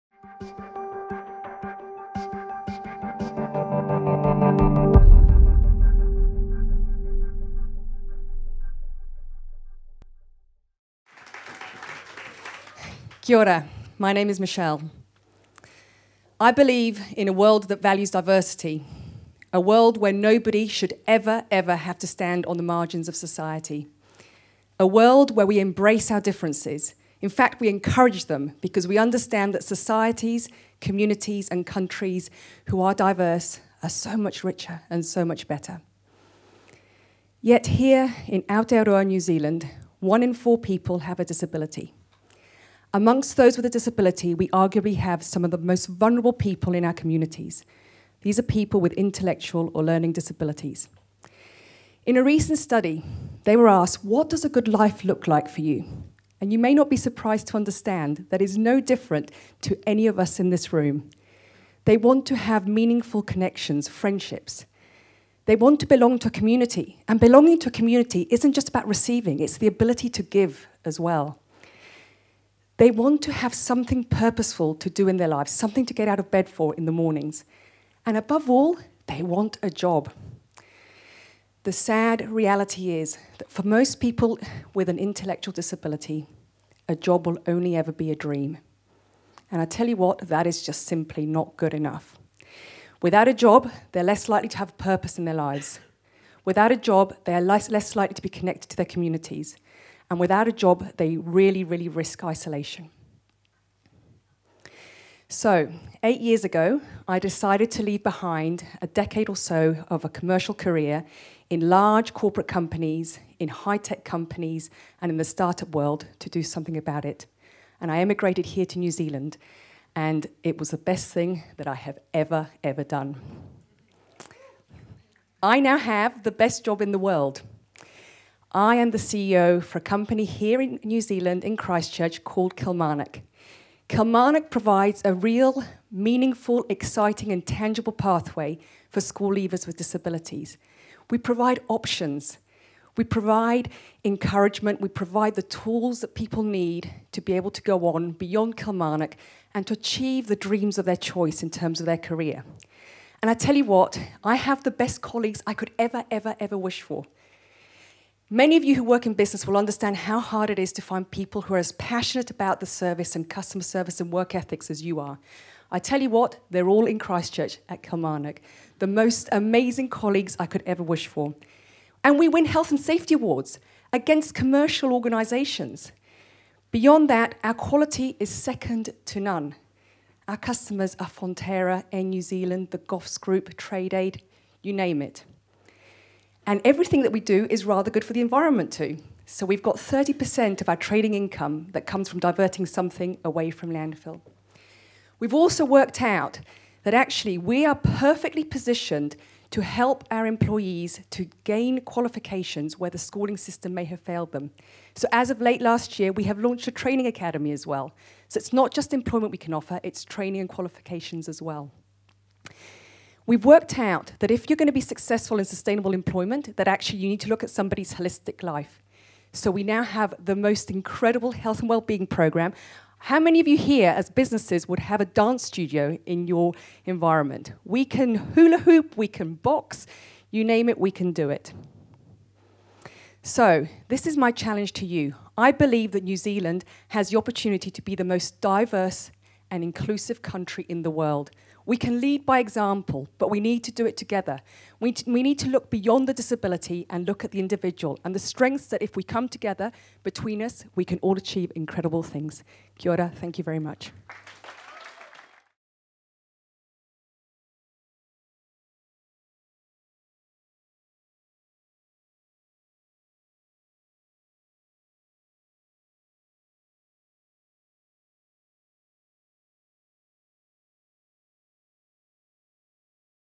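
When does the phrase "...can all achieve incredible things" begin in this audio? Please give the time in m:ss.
4:10.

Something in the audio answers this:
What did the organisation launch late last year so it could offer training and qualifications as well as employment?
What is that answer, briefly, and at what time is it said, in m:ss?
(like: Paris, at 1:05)
training academy, at 3:26.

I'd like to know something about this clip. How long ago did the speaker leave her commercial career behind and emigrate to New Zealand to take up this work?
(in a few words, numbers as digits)
8 years.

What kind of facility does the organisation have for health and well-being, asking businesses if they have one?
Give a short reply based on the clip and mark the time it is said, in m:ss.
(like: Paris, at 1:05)
dance studio, at 3:45.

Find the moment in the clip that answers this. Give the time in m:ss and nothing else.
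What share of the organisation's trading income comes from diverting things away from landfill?
3:09.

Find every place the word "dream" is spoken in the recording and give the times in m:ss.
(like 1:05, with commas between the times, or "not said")
1:28, 2:30.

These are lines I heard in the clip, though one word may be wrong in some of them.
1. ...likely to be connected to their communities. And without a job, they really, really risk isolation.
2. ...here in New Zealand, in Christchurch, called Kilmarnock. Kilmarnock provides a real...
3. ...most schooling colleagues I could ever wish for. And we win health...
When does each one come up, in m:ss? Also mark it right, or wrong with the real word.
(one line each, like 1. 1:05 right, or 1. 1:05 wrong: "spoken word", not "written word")
1. 1:37 right
2. 2:10 right
3. 2:48 wrong: "amazing", not "schooling".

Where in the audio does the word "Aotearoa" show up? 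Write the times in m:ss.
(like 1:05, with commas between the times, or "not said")
0:38.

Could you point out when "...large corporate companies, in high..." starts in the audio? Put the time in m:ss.
1:51.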